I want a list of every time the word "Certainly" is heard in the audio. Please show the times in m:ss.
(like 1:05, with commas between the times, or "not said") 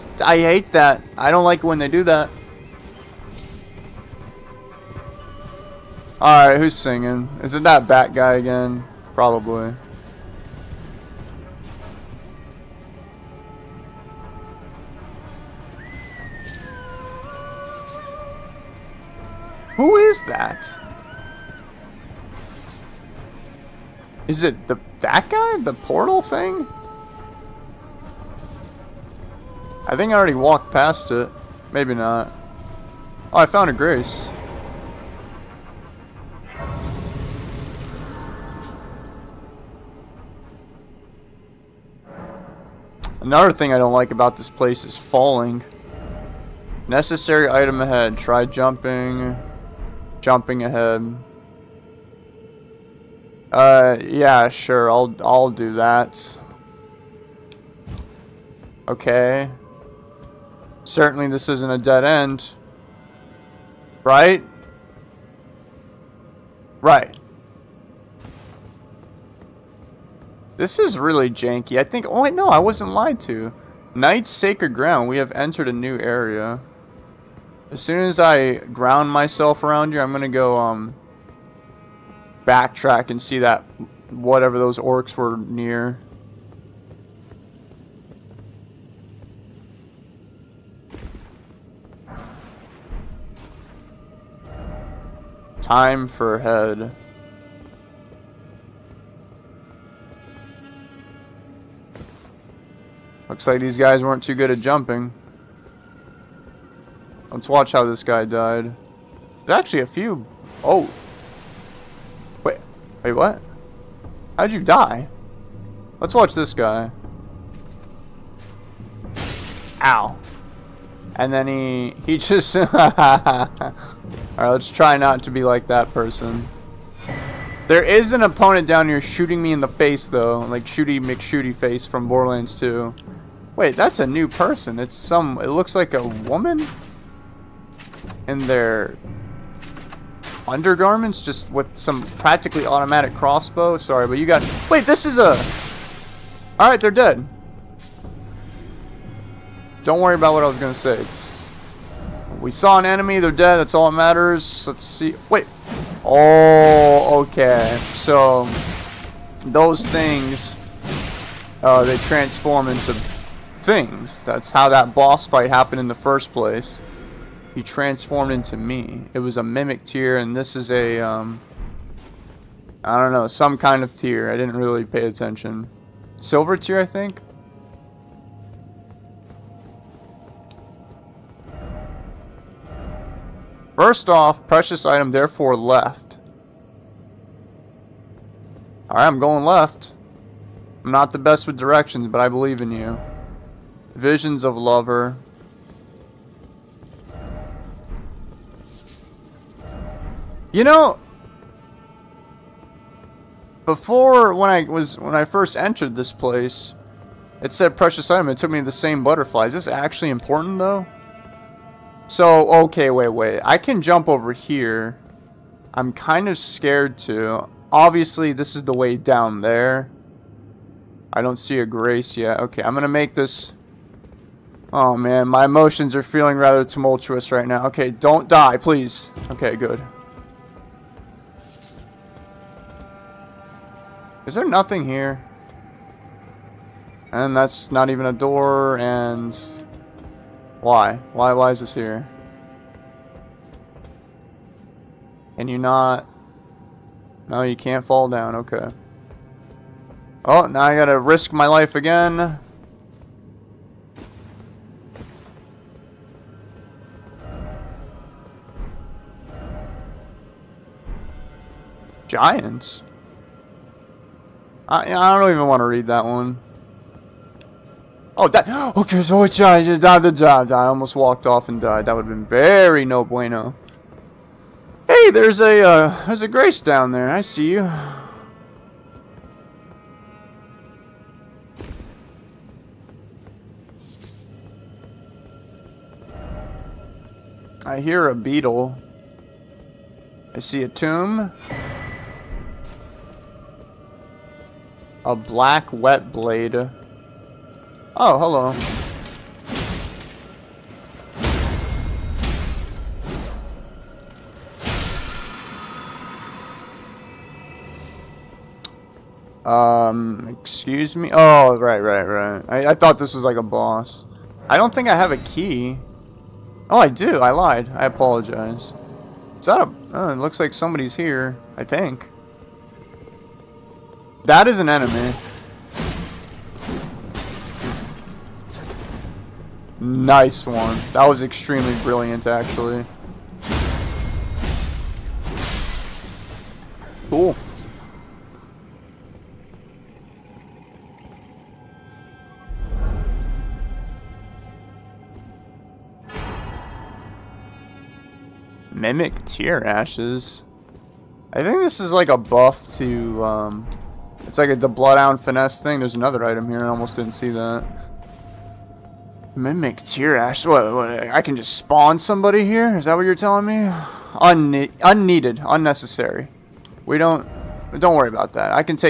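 1:00.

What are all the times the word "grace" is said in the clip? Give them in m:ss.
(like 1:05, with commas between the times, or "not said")
0:33, 3:41, 4:36.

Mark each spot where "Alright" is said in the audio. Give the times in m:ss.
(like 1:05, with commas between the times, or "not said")
0:06, 2:04, 2:26, 3:08.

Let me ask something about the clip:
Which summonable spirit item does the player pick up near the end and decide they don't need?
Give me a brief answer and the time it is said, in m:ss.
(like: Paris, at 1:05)
Mimic Tear Ashes, at 5:48.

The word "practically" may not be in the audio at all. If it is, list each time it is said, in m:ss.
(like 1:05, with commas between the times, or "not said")
2:22.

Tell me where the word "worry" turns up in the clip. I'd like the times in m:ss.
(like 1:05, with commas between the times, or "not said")
2:29, 6:07.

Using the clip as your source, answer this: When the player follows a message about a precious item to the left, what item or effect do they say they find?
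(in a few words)
Visions of Lover.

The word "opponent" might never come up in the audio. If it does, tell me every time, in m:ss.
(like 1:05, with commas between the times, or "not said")
2:08.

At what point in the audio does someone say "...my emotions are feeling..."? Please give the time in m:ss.
3:45.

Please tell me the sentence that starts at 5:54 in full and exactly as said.
It's like a, the Bloodhound Finesse thing.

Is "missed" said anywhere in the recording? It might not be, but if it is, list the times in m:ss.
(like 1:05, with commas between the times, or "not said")
not said.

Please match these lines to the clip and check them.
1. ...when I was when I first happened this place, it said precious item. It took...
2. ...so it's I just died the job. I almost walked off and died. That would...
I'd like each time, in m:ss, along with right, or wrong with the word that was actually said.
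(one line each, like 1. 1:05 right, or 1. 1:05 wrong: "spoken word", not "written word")
1. 3:24 wrong: "entered", not "happened"
2. 4:29 right.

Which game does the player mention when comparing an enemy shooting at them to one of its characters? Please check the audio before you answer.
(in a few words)
Borderlands 2.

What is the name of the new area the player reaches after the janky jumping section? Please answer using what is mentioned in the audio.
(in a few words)
Night's Sacred Ground.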